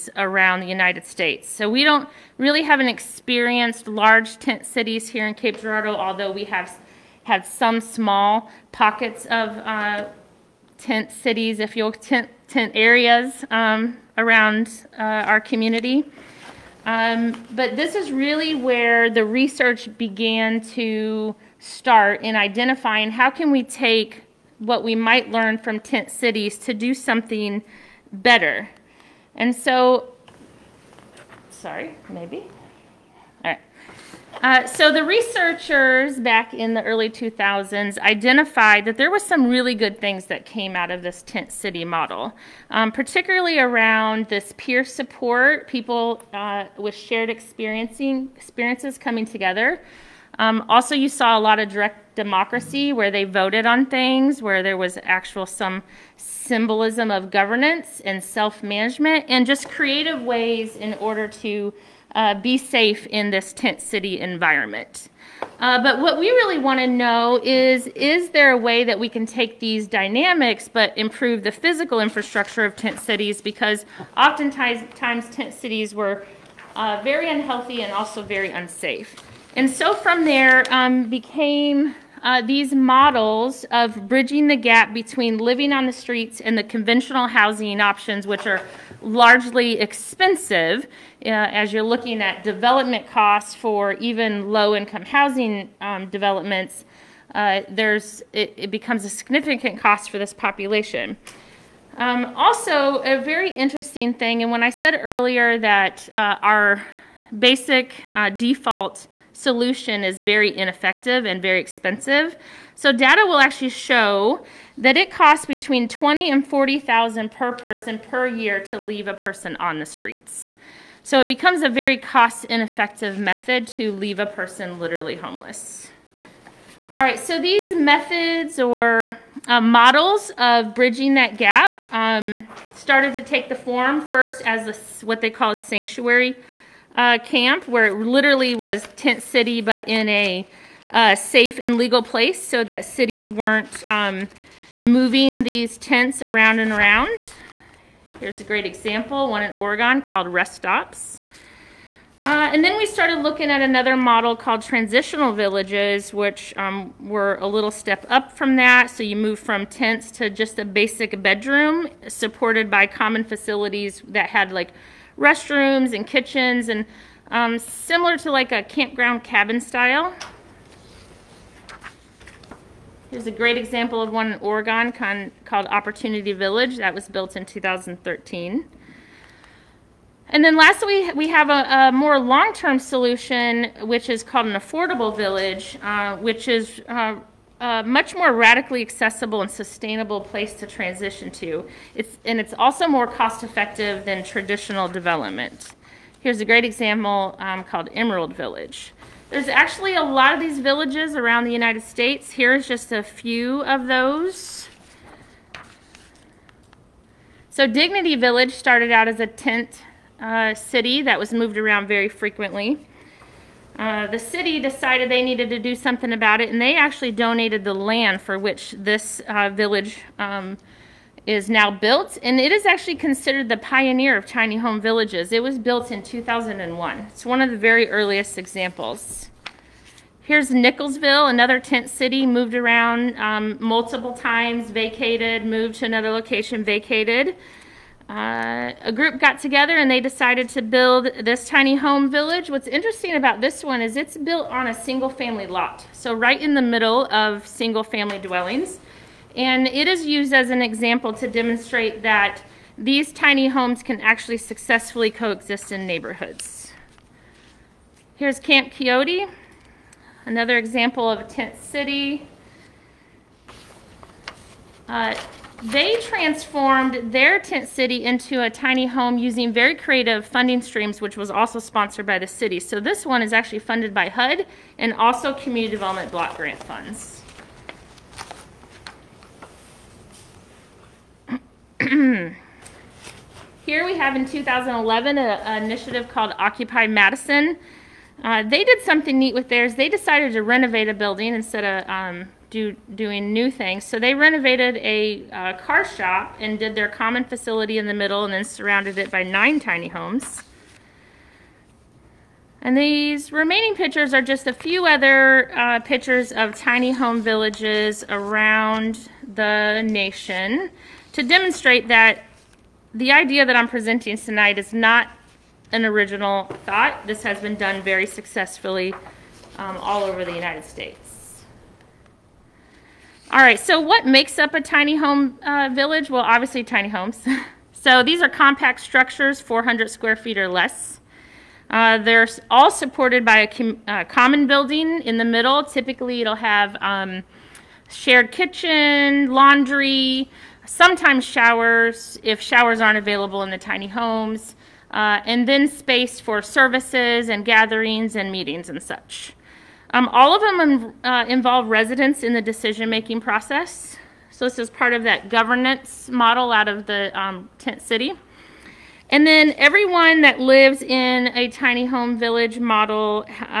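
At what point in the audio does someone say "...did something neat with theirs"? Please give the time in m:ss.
4:48.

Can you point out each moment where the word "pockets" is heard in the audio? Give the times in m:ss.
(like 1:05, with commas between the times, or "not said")
0:08.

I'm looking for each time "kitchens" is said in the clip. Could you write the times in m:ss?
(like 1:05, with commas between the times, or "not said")
2:46, 5:38.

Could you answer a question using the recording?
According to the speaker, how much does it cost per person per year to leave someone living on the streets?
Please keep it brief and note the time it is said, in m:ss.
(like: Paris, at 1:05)
20 to 40,000, at 1:55.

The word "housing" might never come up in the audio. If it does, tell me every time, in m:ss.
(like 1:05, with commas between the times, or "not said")
1:27, 1:35.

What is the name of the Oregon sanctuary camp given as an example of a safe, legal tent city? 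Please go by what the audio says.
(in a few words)
Rest Stops.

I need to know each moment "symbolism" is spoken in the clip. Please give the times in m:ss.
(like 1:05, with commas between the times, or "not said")
0:56.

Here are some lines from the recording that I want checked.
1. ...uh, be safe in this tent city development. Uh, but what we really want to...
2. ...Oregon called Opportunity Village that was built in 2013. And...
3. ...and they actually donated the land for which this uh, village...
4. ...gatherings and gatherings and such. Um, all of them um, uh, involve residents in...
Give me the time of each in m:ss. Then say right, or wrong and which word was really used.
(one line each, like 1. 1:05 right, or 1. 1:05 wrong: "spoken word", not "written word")
1. 1:02 wrong: "environment", not "development"
2. 2:54 right
3. 3:36 right
4. 5:47 wrong: "meetings", not "gatherings".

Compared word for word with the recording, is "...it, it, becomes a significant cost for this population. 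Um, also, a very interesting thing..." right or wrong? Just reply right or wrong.
right.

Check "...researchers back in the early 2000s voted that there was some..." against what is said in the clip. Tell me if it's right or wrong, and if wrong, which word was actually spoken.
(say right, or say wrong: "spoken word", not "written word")
wrong: "identified", not "voted".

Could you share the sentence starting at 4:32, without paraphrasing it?
So this one is actually funded by HUD and also community development block grant funds.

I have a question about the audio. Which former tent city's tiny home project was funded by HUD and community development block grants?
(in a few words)
Camp Quixote.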